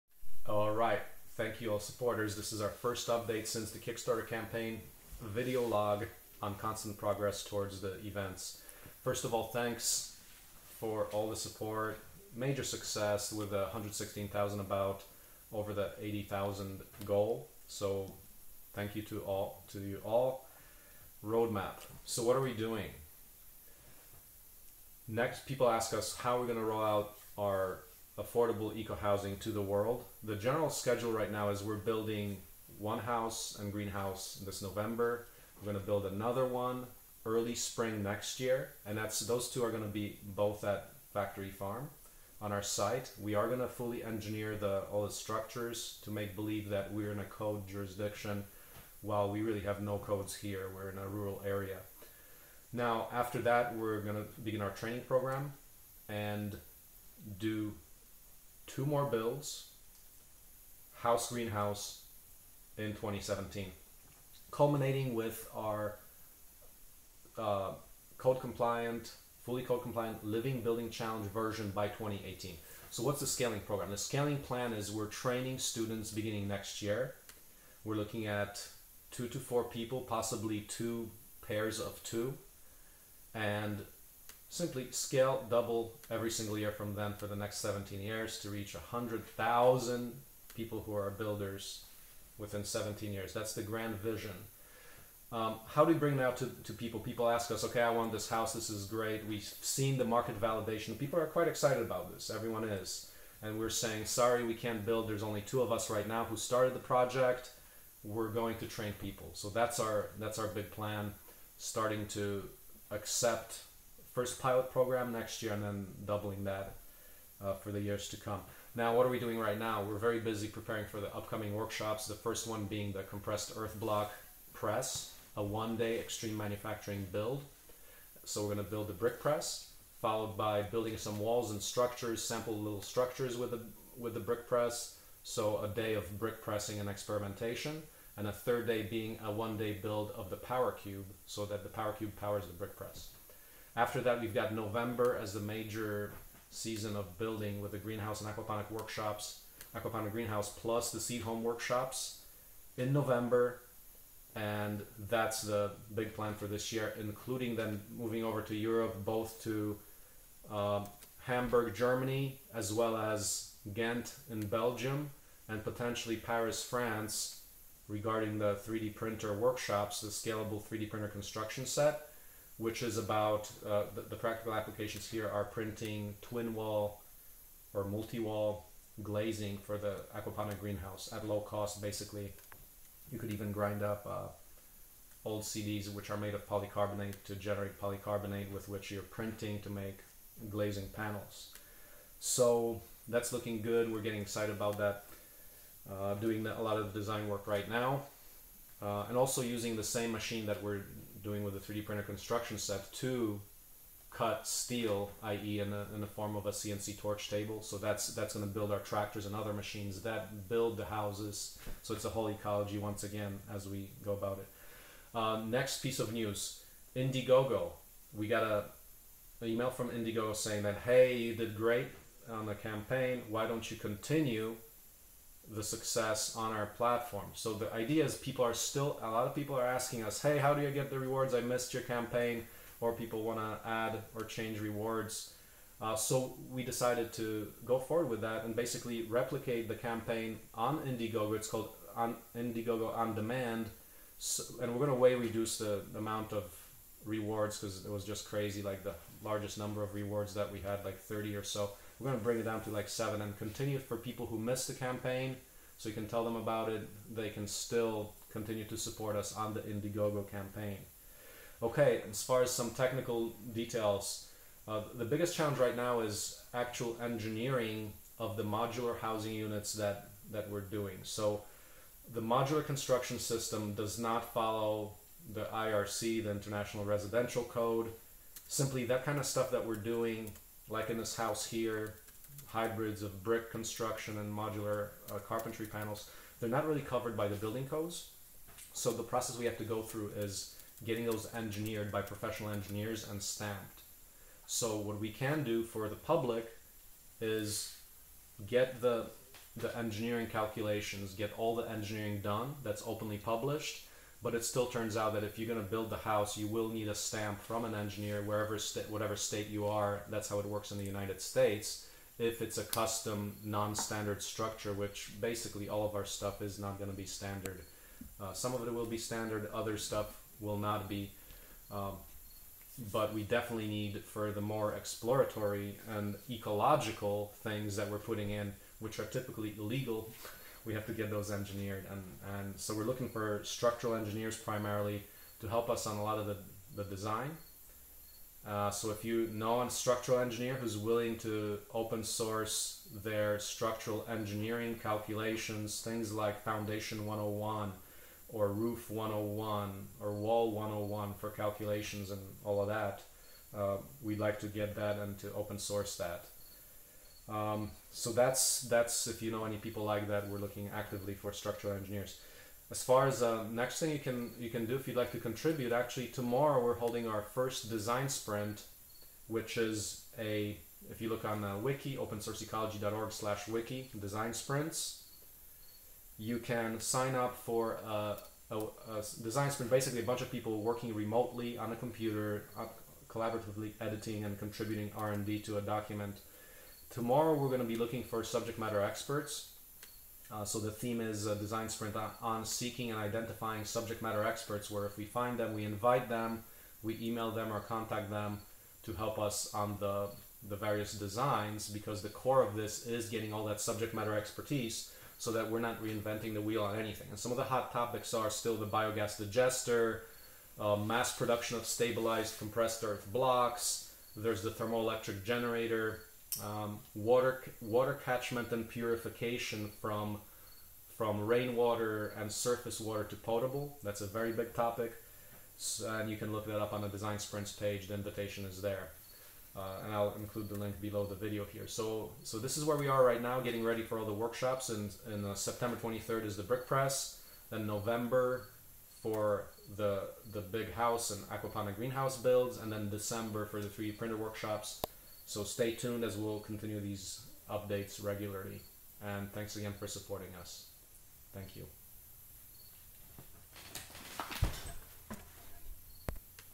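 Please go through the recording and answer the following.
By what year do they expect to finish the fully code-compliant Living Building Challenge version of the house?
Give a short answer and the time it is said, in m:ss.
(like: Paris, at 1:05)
2018, at 1:11.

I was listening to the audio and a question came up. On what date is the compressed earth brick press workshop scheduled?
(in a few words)
September 23rd.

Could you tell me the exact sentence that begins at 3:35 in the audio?
Uh, next piece of news: Indiegogo.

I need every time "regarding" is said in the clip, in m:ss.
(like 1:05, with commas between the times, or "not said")
2:47.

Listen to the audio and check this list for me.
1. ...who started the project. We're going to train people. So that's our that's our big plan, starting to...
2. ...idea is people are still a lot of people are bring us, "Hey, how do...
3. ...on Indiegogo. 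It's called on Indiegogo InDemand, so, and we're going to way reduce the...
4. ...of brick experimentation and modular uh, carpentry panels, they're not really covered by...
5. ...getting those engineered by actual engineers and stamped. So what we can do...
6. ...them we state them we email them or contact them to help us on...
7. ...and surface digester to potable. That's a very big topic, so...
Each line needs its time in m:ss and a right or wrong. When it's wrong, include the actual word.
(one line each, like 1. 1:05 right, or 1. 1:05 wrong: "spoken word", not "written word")
1. 1:46 right
2. 3:47 wrong: "asking", not "bring"
3. 4:00 right
4. 4:43 wrong: "construction", not "experimentation"
5. 4:50 wrong: "professional", not "actual"
6. 6:35 wrong: "invite", not "state"
7. 7:02 wrong: "water", not "digester".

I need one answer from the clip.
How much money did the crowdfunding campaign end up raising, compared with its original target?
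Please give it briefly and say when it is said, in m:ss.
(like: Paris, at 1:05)
116,000, at 0:13.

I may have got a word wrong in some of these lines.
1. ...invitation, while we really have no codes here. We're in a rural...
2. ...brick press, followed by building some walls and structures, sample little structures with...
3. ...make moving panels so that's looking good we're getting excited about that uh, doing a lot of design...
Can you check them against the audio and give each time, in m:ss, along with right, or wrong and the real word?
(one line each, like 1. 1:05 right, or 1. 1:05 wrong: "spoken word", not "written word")
1. 0:47 wrong: "jurisdiction", not "invitation"
2. 2:08 right
3. 3:09 wrong: "glazing", not "moving".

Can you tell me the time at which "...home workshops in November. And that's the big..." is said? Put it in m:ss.
2:31.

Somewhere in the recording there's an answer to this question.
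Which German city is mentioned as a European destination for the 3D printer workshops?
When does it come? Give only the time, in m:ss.
2:41.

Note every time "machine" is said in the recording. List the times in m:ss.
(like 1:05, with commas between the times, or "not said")
3:20, 3:29.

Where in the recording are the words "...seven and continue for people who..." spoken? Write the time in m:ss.
4:12.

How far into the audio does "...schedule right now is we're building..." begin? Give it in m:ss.
0:30.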